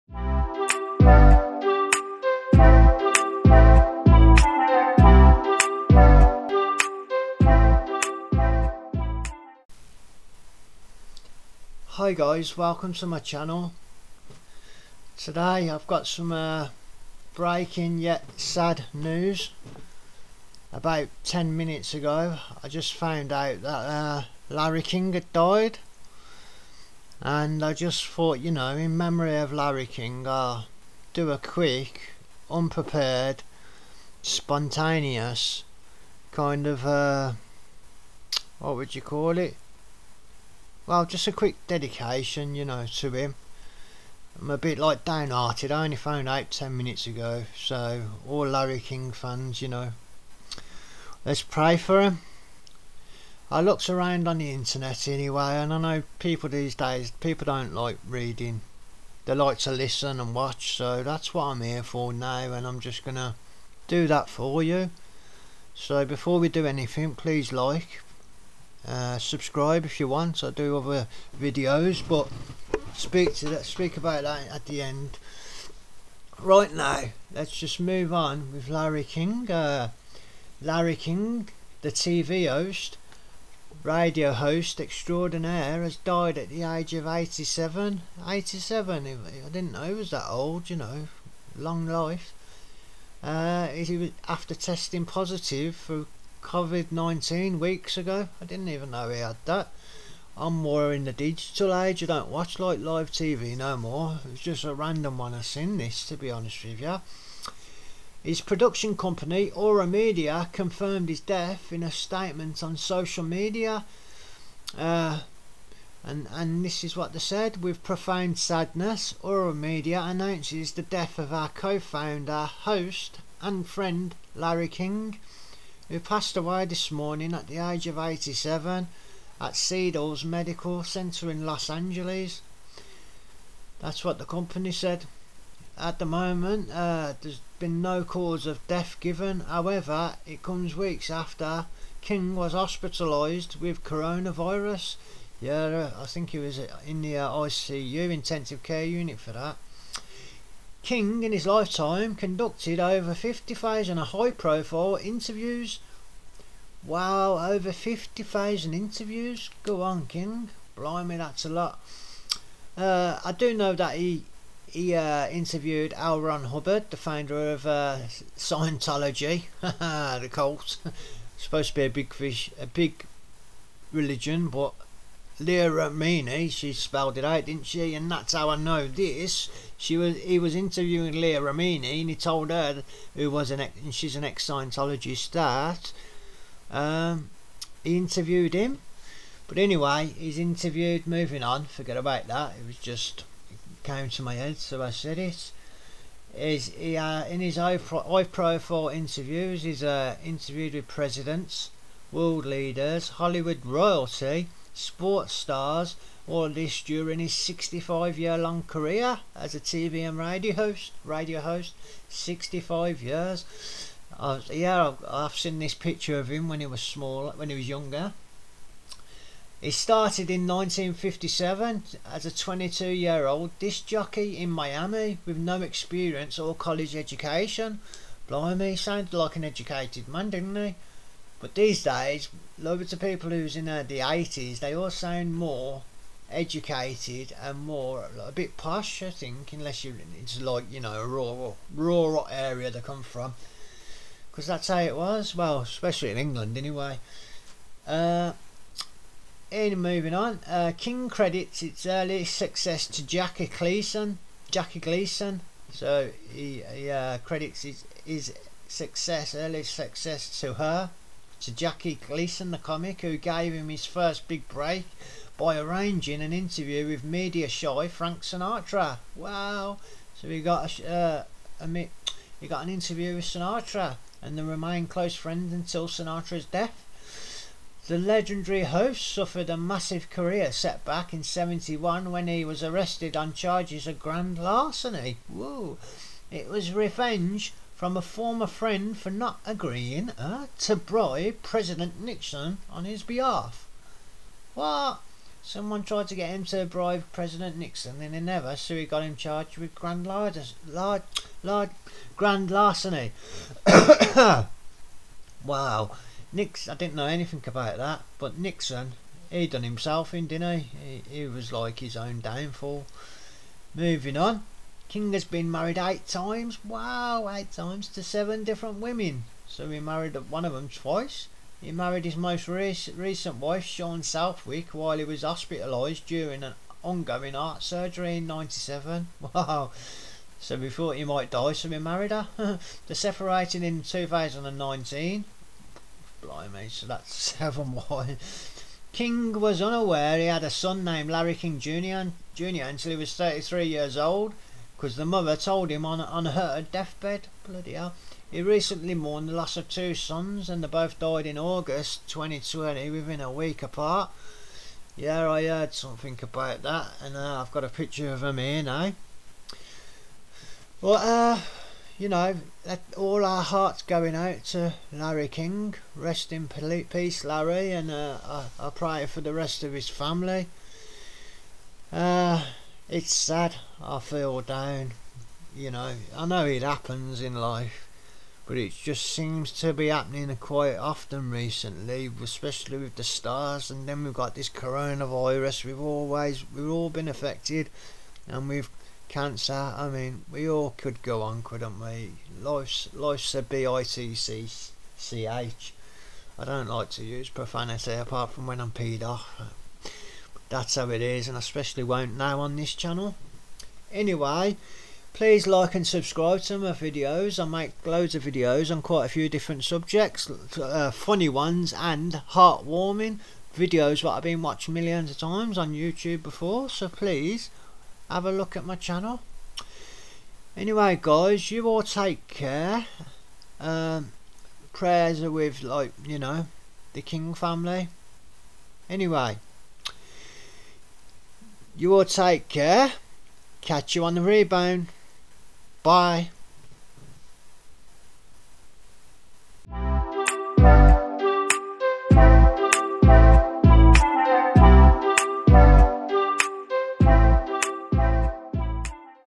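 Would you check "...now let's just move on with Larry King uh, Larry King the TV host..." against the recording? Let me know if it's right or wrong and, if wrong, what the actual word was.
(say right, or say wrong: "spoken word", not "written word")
right.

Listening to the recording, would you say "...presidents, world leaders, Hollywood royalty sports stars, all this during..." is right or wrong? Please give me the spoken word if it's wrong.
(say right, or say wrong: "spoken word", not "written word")
right.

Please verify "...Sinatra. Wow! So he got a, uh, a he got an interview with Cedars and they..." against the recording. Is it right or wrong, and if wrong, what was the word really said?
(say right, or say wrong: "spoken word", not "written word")
wrong: "Sinatra", not "Cedars".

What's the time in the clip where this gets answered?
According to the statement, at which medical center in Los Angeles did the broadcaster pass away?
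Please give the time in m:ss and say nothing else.
2:09.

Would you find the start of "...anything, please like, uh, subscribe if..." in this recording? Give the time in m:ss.
1:06.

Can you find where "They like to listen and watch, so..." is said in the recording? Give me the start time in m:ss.
0:59.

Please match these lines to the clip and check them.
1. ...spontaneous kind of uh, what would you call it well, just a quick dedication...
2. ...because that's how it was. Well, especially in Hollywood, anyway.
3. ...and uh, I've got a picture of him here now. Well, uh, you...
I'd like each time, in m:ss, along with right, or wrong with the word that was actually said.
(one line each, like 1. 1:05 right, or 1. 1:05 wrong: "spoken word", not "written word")
1. 0:34 right
2. 4:04 wrong: "England", not "Hollywood"
3. 5:56 right.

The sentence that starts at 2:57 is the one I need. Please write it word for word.
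And that's how I know this.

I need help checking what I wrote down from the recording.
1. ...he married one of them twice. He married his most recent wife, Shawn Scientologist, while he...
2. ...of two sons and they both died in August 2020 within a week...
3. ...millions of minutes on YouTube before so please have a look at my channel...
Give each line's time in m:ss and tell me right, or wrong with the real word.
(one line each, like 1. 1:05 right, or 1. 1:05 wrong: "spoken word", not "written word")
1. 5:19 wrong: "Southwick", not "Scientologist"
2. 5:49 right
3. 6:54 wrong: "times", not "minutes".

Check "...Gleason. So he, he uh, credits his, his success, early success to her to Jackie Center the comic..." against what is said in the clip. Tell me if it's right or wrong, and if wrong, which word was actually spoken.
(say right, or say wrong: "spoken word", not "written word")
wrong: "Gleason", not "Center".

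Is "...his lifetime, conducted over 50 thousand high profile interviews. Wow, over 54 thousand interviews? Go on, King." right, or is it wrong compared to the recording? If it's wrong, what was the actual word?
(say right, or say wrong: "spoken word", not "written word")
wrong: "50", not "54".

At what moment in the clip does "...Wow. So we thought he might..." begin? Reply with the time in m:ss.
5:29.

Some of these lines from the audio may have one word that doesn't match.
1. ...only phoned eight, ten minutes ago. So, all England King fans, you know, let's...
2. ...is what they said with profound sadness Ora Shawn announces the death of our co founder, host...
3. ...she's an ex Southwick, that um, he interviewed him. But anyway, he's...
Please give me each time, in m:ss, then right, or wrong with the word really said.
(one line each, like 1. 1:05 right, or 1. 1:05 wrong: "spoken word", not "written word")
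1. 0:45 wrong: "Larry", not "England"
2. 1:56 wrong: "Media", not "Shawn"
3. 3:03 wrong: "Scientologist", not "Southwick".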